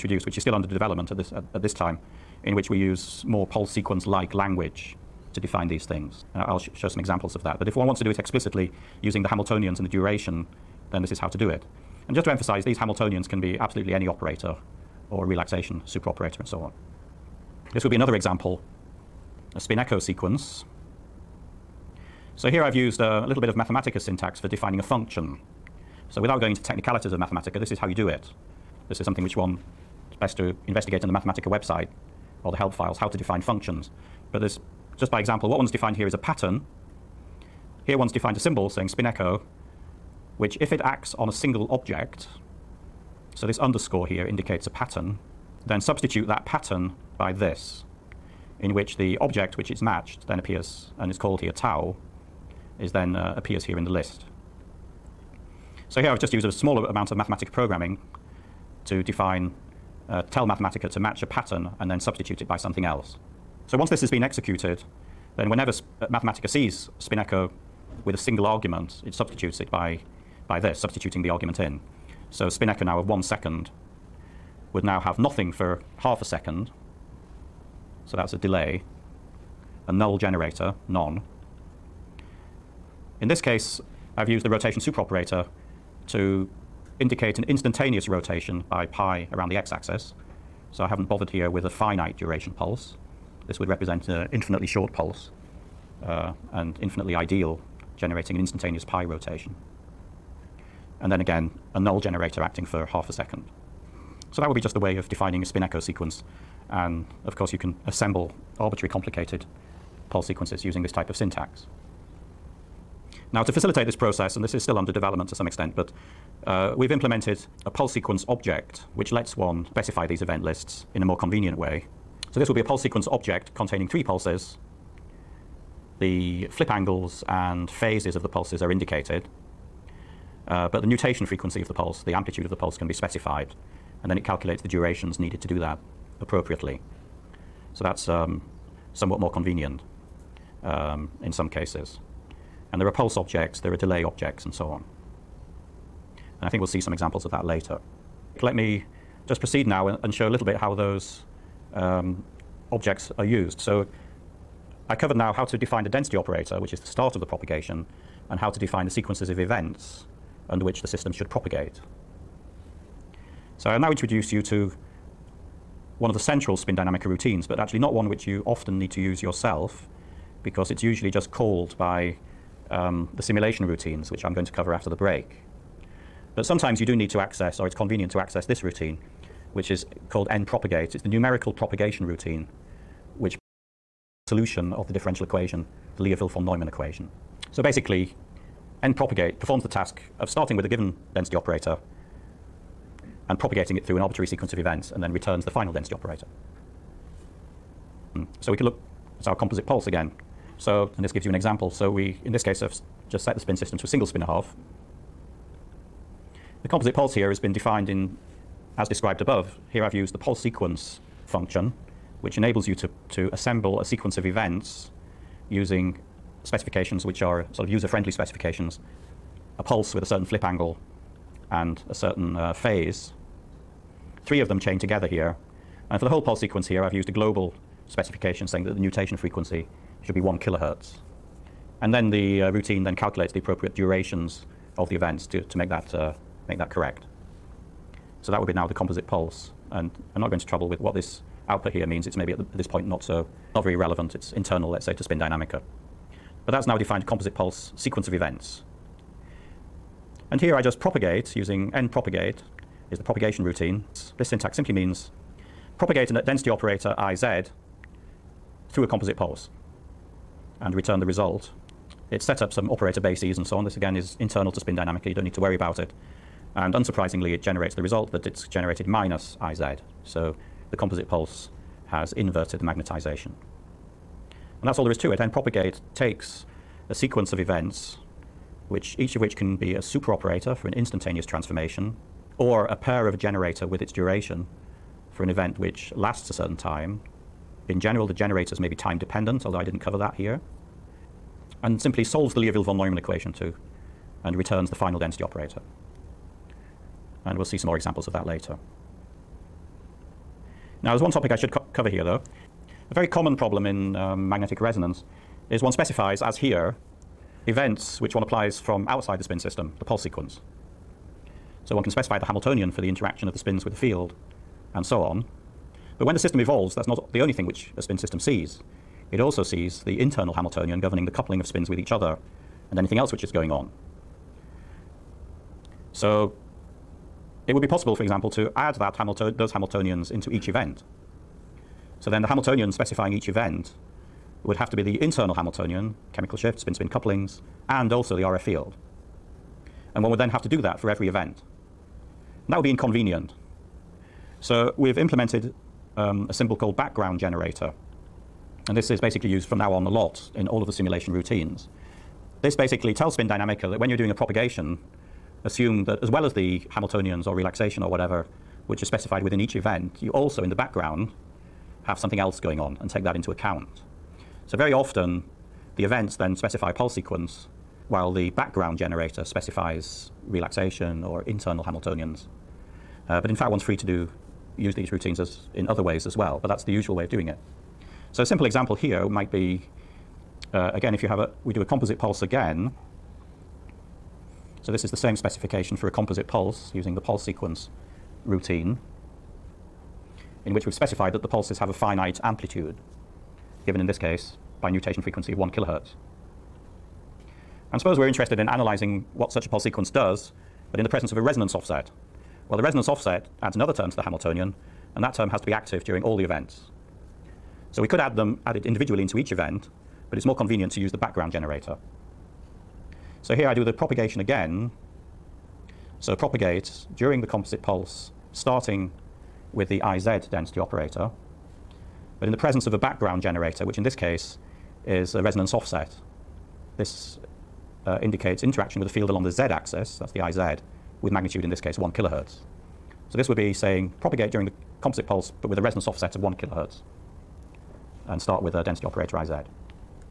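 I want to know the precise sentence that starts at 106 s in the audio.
And of course, you can assemble arbitrary complicated pulse sequences using this type of syntax.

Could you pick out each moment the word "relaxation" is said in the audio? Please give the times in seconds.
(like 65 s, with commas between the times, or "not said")
15 s, 357 s, 370 s.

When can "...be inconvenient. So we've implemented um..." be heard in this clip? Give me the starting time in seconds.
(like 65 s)
342 s.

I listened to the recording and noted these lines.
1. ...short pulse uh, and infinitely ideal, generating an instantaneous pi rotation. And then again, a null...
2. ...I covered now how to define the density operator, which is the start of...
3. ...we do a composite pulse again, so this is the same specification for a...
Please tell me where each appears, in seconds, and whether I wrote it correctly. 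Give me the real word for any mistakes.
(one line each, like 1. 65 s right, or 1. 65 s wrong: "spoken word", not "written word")
1. 94 s right
2. 154 s right
3. 381 s right.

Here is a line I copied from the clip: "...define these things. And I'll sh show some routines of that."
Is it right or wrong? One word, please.
wrong.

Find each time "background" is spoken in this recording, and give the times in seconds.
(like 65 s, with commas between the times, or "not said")
346 s, 360 s, 368 s, 410 s, 422 s.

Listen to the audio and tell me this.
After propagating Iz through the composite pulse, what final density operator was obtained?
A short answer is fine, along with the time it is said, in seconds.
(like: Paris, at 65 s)
minus Iz, at 268 s.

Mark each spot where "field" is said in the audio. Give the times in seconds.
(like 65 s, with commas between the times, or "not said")
313 s, 338 s, 428 s.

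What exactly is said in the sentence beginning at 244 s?
It's internal, let's say, to spin dynamica.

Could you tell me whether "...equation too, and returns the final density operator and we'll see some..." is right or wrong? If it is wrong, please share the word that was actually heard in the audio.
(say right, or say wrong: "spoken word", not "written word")
right.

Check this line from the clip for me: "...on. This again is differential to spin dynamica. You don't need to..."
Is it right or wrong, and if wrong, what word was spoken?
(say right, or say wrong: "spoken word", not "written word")
wrong: "internal", not "differential".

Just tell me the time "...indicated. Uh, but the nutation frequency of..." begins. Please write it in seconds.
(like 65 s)
128 s.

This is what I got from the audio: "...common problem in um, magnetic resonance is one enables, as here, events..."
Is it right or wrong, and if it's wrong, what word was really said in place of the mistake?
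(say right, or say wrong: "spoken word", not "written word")
wrong: "specifies", not "enables".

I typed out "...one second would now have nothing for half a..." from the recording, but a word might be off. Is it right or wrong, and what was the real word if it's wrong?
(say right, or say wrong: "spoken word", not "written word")
right.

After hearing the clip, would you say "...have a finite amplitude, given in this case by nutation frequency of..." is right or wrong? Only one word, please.
right.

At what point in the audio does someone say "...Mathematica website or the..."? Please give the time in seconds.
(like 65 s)
31 s.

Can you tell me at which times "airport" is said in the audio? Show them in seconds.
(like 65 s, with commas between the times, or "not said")
not said.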